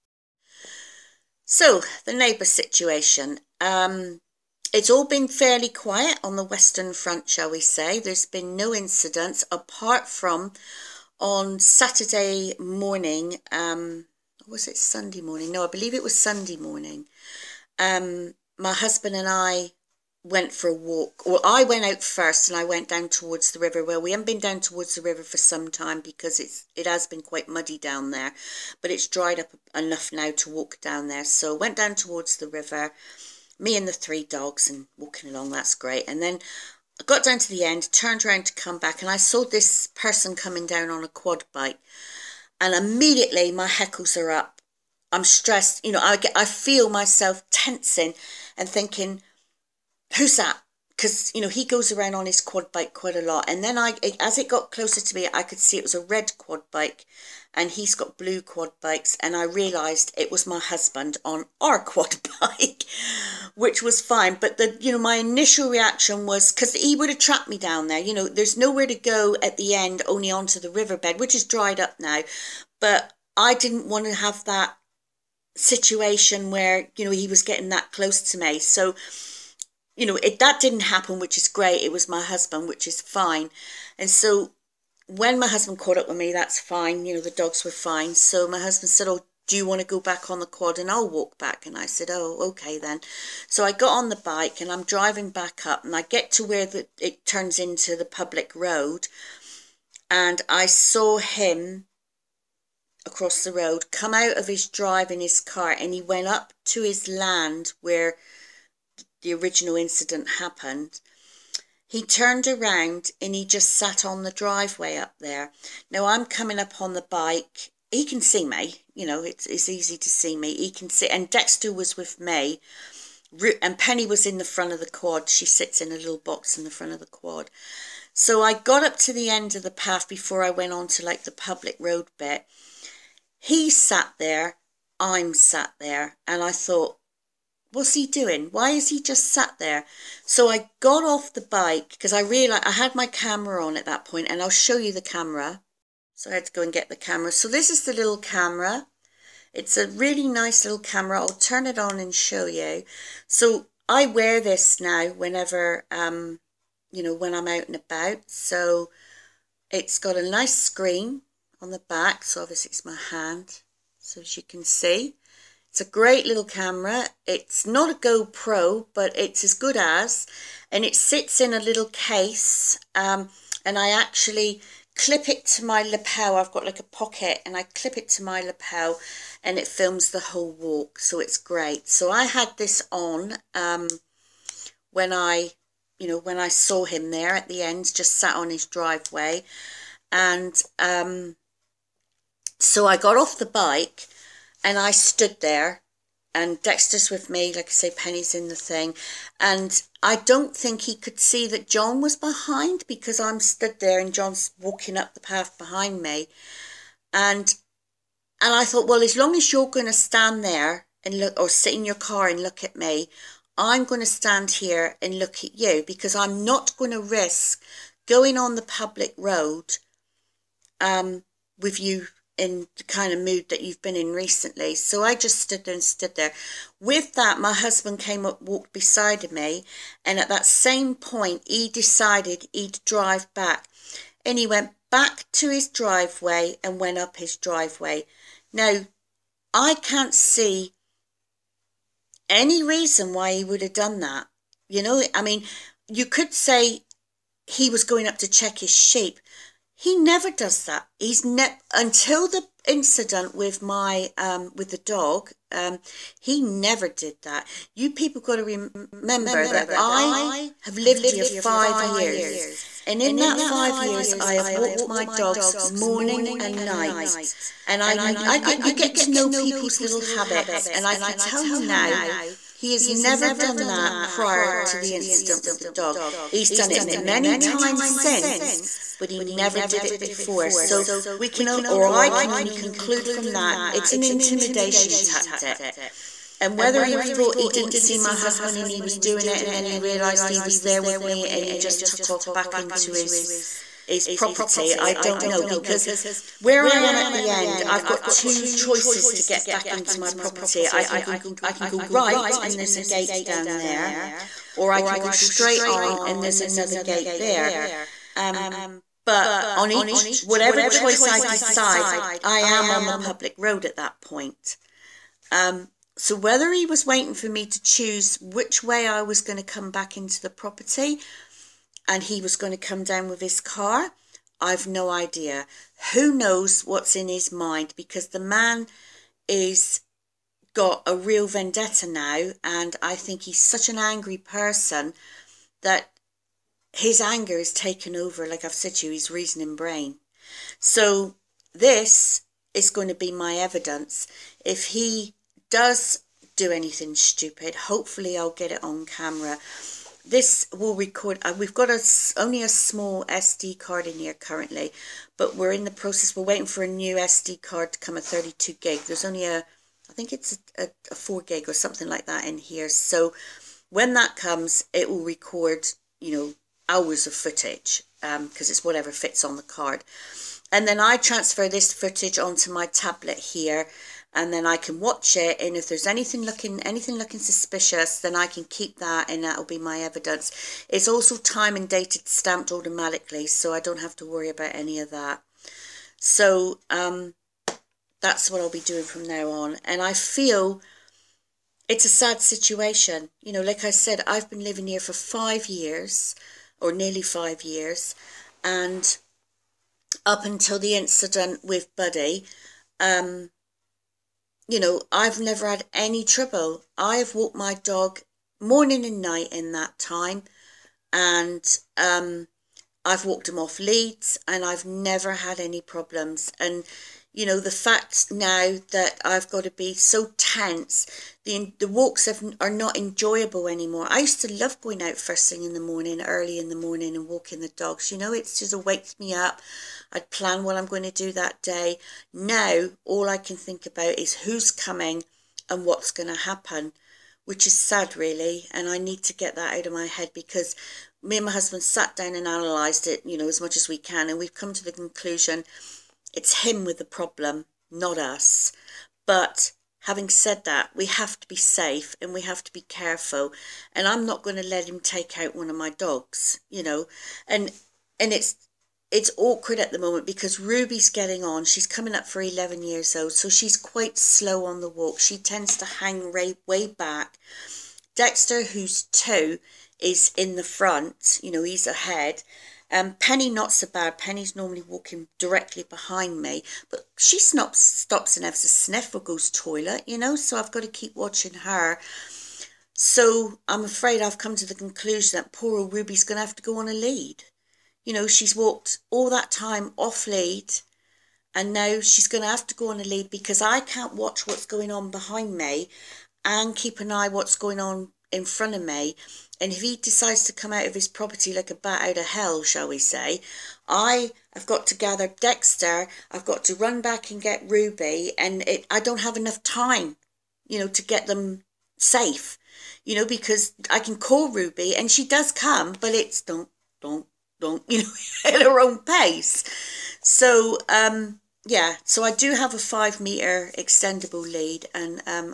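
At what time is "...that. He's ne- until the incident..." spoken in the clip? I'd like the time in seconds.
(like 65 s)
250 s.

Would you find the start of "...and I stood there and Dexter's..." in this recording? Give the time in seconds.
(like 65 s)
194 s.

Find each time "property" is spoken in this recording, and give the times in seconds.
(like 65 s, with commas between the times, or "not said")
294 s, 300 s, 320 s, 500 s.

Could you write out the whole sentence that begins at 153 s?
So I wear this now whenever, um, you know, when I'm out and about.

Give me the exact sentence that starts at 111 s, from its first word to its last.
He turned around and he just sat on the driveway up there.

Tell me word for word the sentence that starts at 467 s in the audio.
Dexter, who's two, is in the front, you know, he's ahead.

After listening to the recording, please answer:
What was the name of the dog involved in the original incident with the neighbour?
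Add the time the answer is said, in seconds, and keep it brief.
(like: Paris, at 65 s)
Buddy, at 401 s.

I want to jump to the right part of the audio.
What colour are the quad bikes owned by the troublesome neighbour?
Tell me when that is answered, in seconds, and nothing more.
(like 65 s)
58 s.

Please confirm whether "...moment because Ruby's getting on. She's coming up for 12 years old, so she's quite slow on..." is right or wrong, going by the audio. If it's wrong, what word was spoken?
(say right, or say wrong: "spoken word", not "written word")
wrong: "11", not "12".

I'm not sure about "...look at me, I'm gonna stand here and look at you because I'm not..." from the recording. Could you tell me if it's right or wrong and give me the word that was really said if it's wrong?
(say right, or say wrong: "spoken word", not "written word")
right.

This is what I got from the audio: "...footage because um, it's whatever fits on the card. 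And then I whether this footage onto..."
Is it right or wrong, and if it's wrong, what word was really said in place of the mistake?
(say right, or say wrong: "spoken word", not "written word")
wrong: "transfer", not "whether".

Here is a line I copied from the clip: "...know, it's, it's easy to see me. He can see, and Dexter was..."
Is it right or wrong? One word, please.
right.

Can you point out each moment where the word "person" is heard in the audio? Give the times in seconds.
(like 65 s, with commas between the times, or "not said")
39 s, 334 s.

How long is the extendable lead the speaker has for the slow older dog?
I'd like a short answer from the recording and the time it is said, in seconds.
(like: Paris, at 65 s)
5 meters, at 522 s.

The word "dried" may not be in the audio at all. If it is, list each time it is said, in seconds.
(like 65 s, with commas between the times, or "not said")
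29 s, 71 s.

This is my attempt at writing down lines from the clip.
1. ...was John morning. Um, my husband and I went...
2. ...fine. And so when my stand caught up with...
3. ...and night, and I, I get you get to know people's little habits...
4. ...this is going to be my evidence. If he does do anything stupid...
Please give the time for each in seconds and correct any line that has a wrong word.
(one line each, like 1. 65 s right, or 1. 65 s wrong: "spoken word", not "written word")
1. 16 s wrong: "Sunday", not "John"
2. 83 s wrong: "husband", not "stand"
3. 266 s right
4. 341 s right.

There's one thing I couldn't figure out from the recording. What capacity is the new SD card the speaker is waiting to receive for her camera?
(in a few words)
32 gig.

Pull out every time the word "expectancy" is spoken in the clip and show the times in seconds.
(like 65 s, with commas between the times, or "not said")
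not said.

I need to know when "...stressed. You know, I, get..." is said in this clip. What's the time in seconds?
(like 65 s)
45 s.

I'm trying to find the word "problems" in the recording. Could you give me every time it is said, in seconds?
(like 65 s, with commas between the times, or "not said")
415 s, 446 s.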